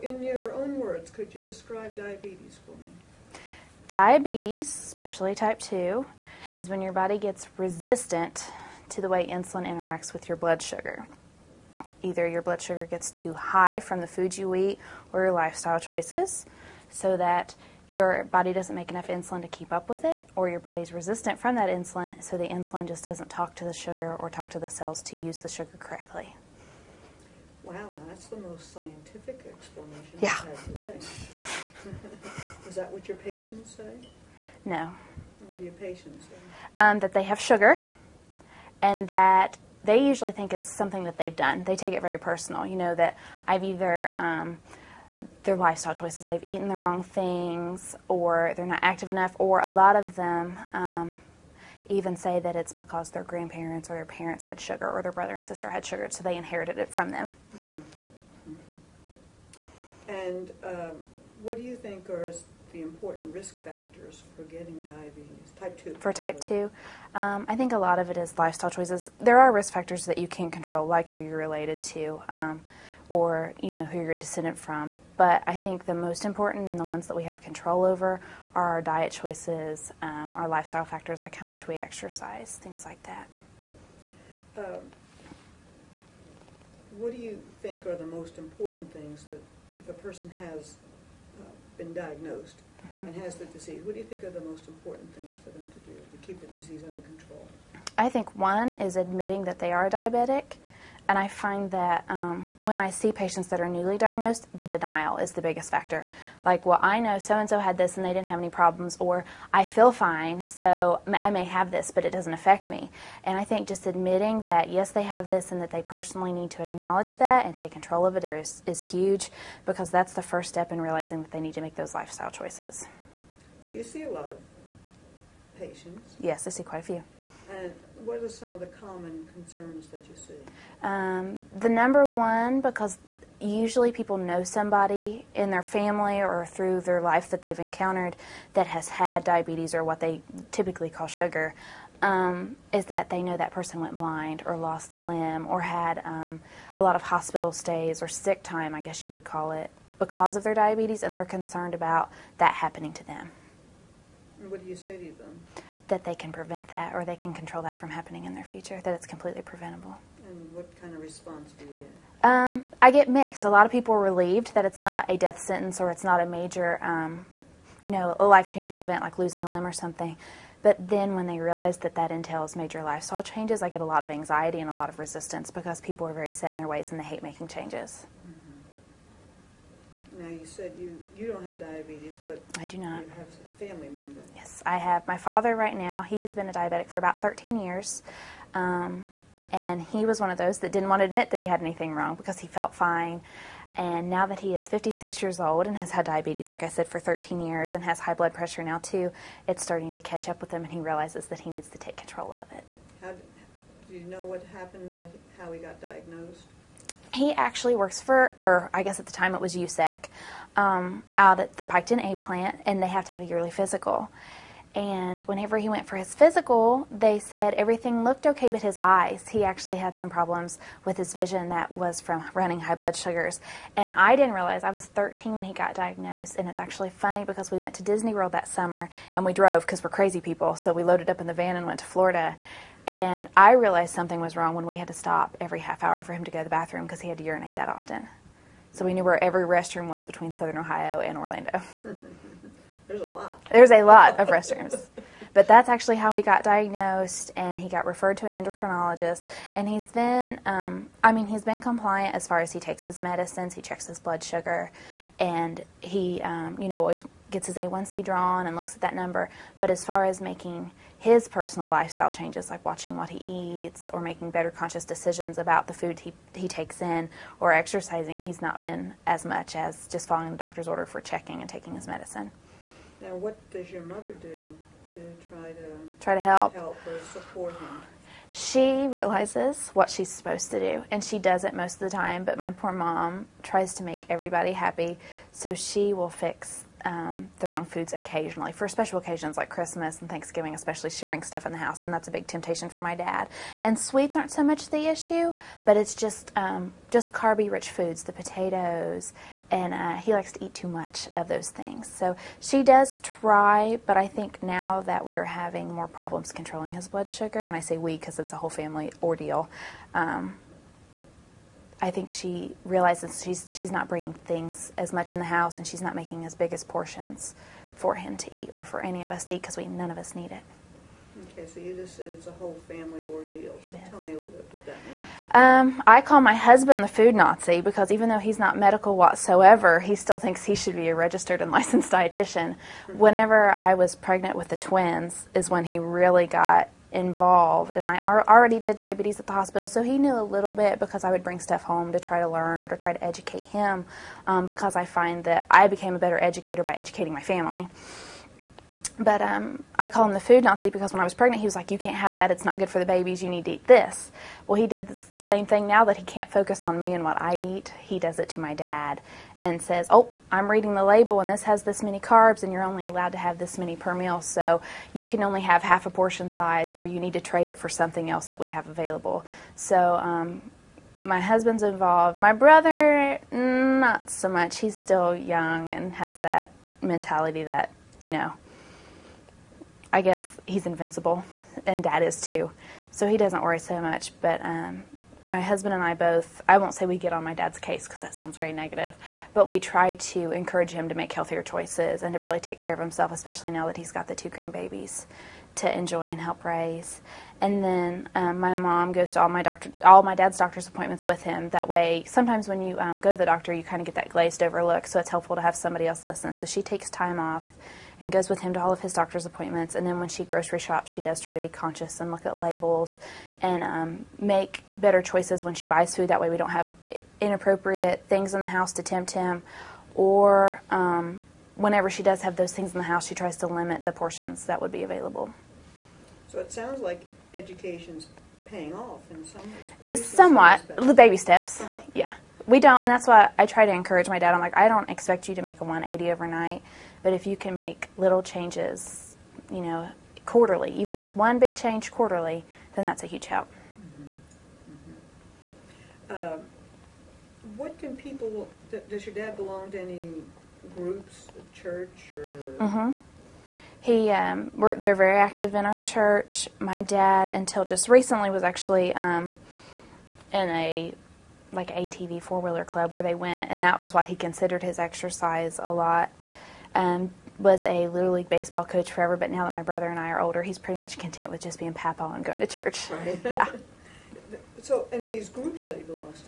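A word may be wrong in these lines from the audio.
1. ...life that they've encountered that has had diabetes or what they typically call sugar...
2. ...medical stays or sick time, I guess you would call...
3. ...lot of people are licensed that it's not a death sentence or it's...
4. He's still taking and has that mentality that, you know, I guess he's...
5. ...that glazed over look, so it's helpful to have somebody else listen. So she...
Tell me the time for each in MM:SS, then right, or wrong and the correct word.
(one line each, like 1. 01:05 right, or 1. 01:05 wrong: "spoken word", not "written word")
1. 02:17 right
2. 02:27 wrong: "hospital", not "medical"
3. 02:43 wrong: "relieved", not "licensed"
4. 06:14 wrong: "young", not "taking"
5. 06:43 right.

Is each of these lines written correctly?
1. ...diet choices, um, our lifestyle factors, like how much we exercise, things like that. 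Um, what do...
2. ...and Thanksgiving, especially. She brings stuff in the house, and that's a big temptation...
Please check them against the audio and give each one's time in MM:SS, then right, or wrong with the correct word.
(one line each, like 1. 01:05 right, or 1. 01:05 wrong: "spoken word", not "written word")
1. 01:18 right
2. 04:49 right.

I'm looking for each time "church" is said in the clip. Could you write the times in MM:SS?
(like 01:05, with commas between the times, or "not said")
07:31, 07:35, 07:52.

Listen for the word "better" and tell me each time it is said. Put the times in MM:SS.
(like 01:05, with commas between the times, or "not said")
04:24, 05:45, 06:54.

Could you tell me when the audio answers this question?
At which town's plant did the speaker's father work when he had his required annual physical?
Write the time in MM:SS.
03:31.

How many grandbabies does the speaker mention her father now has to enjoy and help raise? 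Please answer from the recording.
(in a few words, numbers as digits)
2.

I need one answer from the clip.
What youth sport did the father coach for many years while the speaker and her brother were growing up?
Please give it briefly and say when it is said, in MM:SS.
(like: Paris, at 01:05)
Little league baseball, at 07:47.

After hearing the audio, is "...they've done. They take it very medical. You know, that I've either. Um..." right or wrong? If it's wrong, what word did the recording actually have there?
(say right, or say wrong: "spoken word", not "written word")
wrong: "personal", not "medical".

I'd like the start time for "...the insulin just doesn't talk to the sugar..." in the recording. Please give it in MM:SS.
00:22.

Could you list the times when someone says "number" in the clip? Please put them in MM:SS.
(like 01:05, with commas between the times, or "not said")
02:11, 04:18.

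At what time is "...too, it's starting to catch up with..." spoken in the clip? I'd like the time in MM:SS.
03:18.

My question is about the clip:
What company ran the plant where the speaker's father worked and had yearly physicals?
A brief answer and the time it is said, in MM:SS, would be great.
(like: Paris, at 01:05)
USEC, at 03:29.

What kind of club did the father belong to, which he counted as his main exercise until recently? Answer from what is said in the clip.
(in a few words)
ATV four wheeler club.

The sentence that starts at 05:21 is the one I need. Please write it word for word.
Okay, so you just said it's a whole family ordeal.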